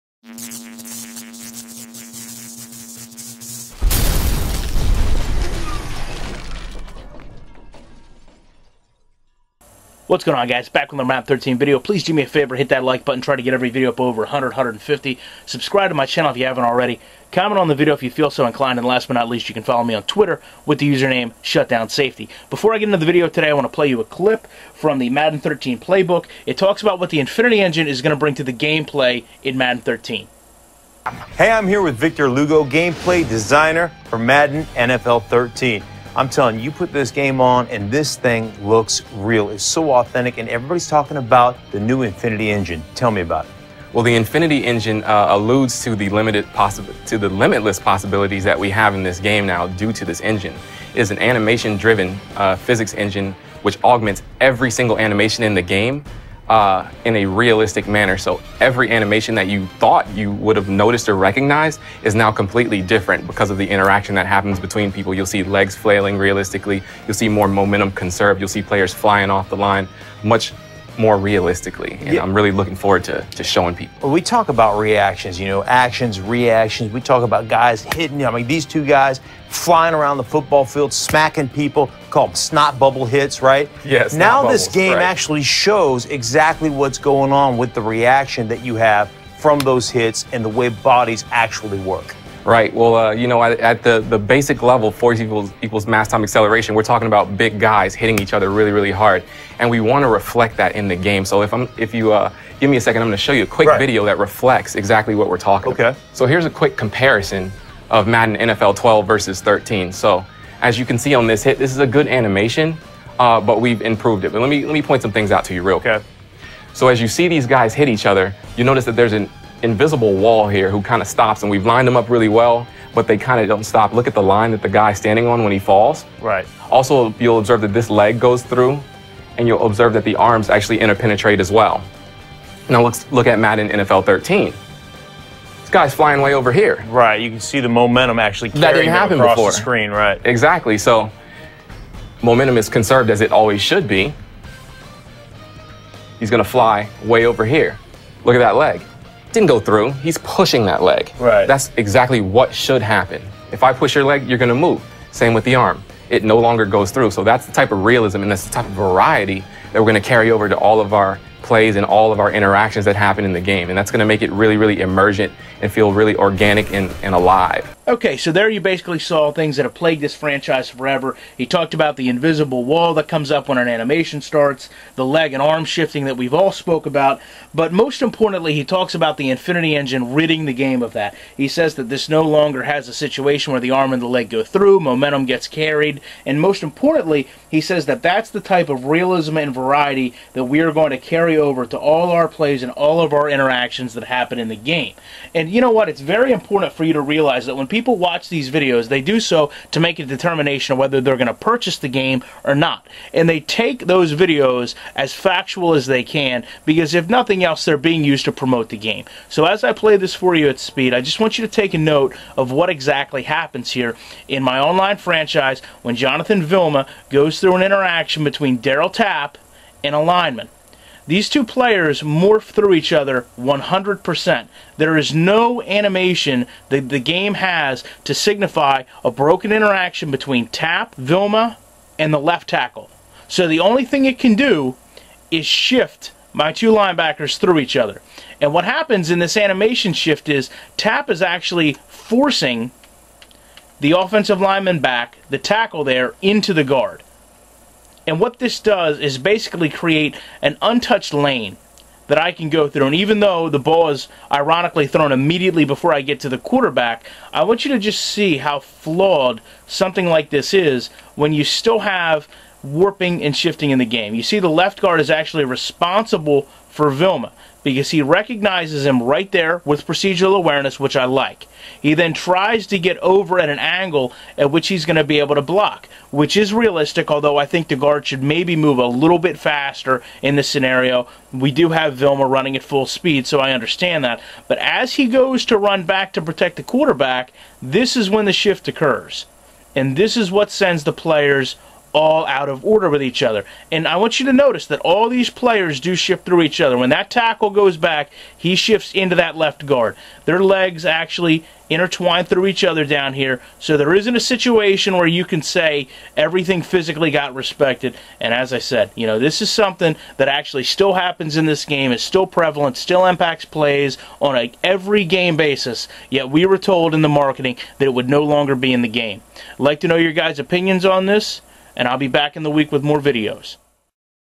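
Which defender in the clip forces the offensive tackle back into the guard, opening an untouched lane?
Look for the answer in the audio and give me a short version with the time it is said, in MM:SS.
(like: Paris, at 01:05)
Darryl Tapp, at 03:38.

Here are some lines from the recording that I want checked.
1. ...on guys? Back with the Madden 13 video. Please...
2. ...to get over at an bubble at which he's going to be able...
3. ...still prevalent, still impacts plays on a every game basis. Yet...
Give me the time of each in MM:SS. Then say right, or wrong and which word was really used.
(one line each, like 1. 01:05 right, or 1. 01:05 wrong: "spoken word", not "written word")
1. 00:10 right
2. 04:32 wrong: "angle", not "bubble"
3. 05:12 right.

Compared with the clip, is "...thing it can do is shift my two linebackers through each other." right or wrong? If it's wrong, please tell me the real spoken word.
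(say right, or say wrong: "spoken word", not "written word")
right.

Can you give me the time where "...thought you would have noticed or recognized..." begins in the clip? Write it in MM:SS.
00:59.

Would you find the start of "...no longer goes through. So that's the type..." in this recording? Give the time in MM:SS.
02:36.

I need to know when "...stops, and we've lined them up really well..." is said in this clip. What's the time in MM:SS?
02:01.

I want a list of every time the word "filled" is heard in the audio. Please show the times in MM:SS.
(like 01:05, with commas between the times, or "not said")
not said.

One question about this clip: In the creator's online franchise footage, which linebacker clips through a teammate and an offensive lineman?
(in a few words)
Jonathan Vilma.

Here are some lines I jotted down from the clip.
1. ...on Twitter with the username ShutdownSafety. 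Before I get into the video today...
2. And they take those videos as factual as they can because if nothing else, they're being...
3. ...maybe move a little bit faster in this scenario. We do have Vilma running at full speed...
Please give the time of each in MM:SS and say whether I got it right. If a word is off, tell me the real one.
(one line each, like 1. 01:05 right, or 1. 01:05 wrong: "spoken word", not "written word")
1. 00:19 right
2. 03:23 right
3. 04:38 right.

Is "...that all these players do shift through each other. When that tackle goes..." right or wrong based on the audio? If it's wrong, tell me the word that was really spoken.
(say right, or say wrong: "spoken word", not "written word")
right.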